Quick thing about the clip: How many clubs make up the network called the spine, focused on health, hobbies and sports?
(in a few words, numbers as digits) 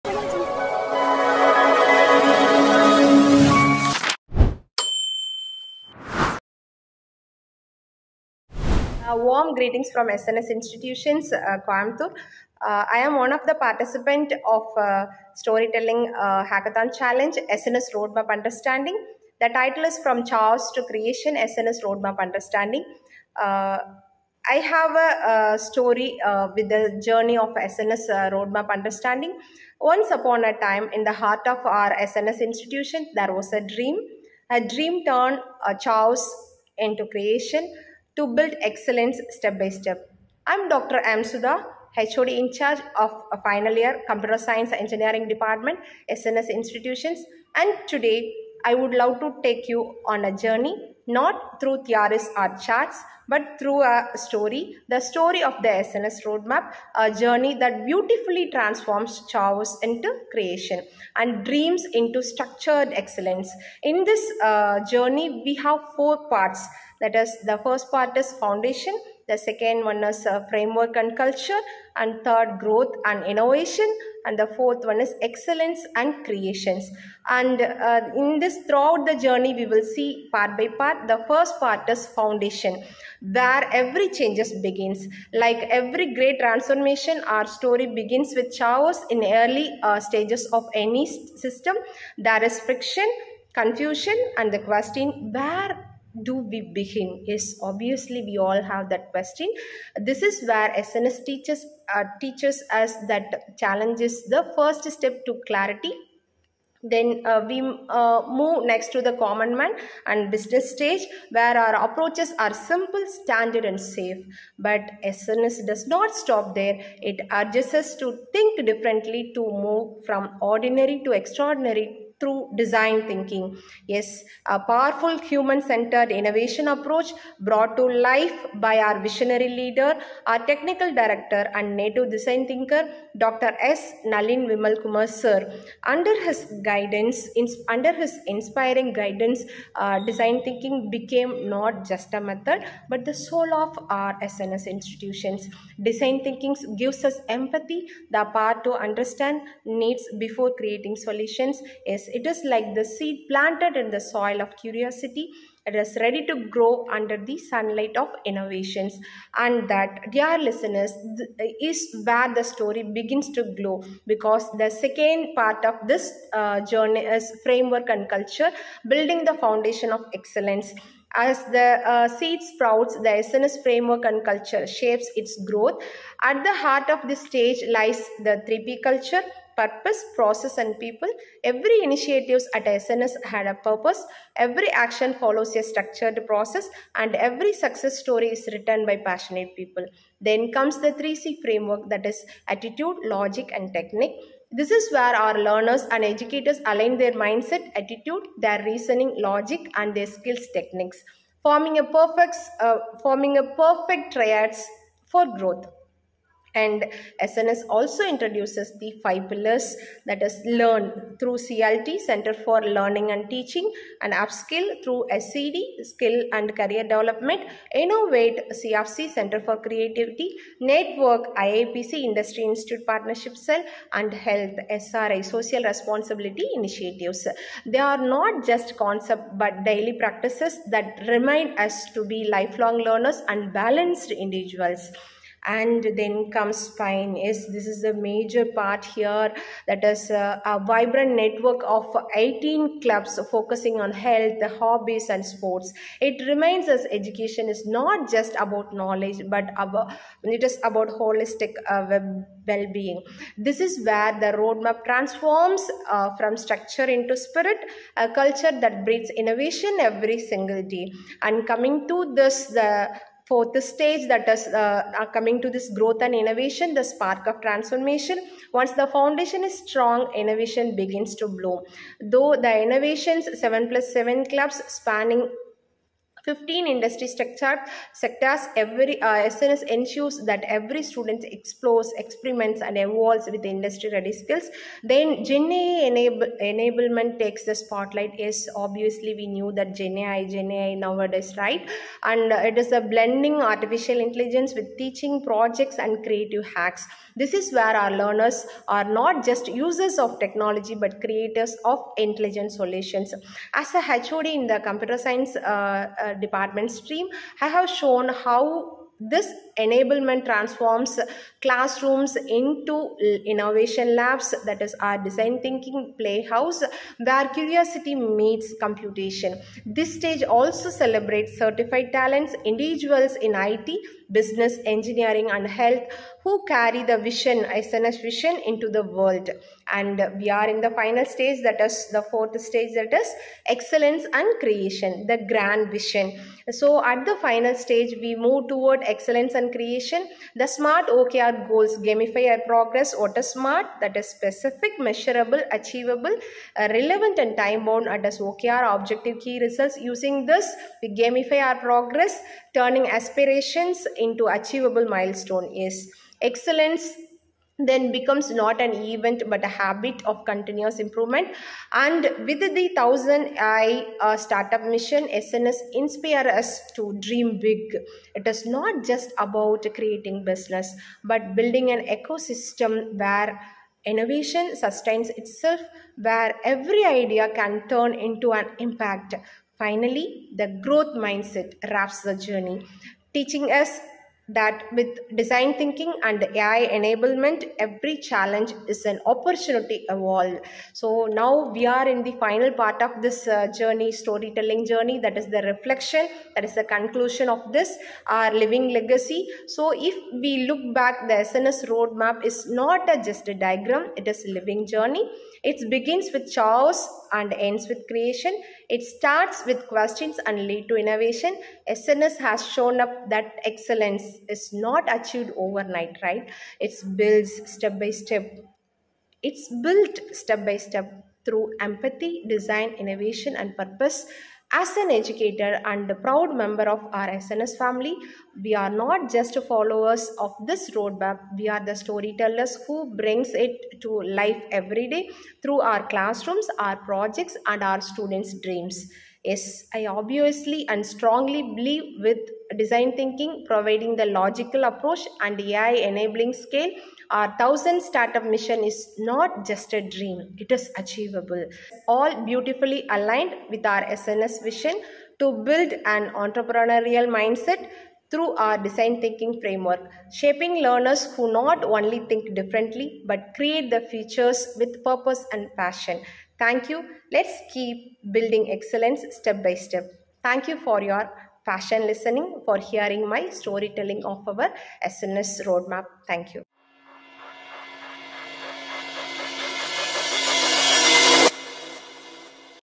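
18.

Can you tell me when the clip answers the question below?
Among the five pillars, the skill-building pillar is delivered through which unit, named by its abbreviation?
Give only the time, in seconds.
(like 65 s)
215 s.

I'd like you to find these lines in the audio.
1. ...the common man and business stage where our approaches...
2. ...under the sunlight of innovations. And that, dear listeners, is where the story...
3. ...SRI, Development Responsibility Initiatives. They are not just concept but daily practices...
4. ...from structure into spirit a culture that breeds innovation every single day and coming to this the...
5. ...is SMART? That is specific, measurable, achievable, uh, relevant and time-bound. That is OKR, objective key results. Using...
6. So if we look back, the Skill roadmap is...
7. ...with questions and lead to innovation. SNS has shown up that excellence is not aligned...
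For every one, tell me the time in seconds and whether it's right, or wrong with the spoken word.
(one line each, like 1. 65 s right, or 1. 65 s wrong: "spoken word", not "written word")
1. 109 s right
2. 156 s right
3. 224 s wrong: "Social", not "Development"
4. 256 s right
5. 343 s right
6. 399 s wrong: "SNS", not "Skill"
7. 409 s wrong: "achieved", not "aligned".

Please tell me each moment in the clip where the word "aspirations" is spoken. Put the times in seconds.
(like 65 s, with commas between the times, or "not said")
352 s.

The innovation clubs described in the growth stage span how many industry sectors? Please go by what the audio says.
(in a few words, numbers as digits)
15.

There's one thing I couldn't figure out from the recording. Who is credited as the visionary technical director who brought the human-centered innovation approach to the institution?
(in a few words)
Dr. 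S. Nalin Vimal Kumar.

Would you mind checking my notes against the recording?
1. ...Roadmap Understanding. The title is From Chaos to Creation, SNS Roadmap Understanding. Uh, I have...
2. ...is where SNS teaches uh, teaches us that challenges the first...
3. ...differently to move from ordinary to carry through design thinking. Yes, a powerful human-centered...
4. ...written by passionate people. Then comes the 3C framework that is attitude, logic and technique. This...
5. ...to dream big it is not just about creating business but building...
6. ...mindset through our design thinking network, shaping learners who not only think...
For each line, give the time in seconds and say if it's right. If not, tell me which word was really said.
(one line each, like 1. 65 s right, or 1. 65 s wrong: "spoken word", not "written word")
1. 17 s right
2. 100 s right
3. 118 s wrong: "extraordinary", not "carry"
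4. 188 s right
5. 366 s right
6. 457 s wrong: "framework", not "network".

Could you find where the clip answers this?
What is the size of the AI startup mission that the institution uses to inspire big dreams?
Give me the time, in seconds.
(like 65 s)
362 s.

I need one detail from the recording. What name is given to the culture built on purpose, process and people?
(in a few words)
3P culture.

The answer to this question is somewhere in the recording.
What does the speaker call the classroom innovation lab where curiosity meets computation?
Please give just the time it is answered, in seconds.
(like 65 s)
314 s.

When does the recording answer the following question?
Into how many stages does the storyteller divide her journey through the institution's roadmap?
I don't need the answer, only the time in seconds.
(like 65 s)
65 s.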